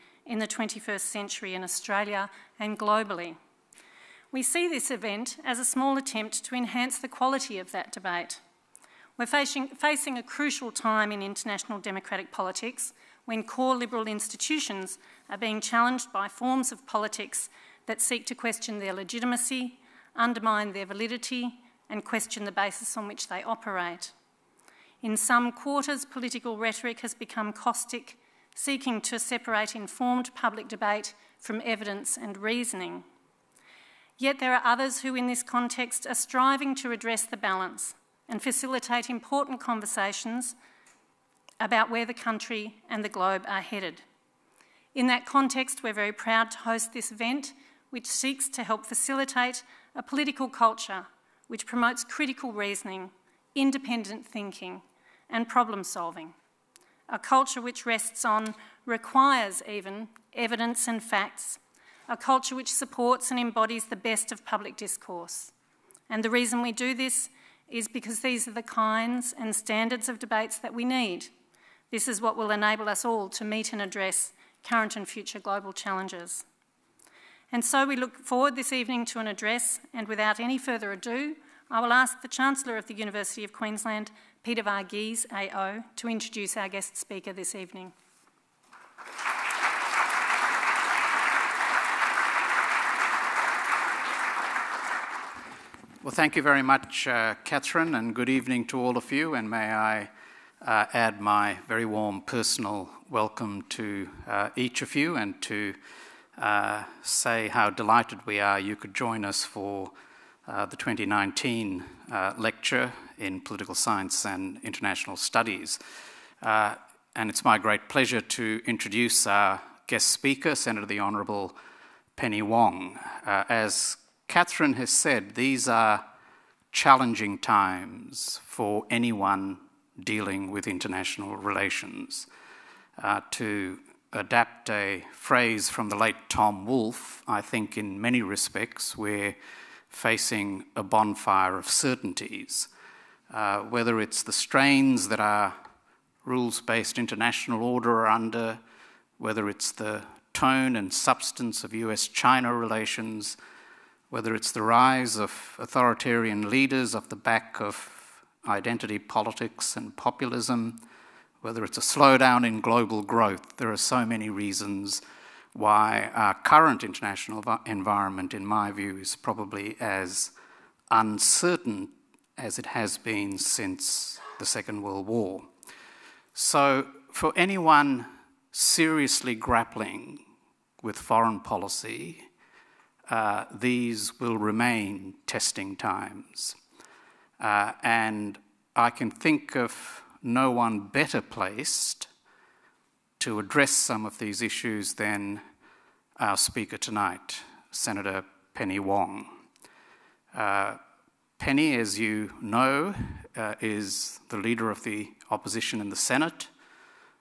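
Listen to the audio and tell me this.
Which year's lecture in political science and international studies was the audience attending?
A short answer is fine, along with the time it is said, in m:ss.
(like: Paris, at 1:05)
2019, at 1:50.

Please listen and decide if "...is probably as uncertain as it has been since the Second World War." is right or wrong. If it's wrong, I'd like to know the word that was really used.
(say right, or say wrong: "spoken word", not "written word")
right.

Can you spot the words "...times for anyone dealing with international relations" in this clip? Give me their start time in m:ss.
2:07.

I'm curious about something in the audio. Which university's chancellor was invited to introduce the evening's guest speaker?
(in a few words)
University of Queensland.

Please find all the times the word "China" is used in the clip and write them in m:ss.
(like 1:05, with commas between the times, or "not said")
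2:32.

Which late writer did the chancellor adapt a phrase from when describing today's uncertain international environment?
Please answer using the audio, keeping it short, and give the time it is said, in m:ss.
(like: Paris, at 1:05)
Tom Wolfe, at 2:16.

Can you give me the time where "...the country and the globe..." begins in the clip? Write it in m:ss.
0:42.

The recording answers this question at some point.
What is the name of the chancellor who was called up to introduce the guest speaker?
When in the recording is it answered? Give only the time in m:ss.
1:24.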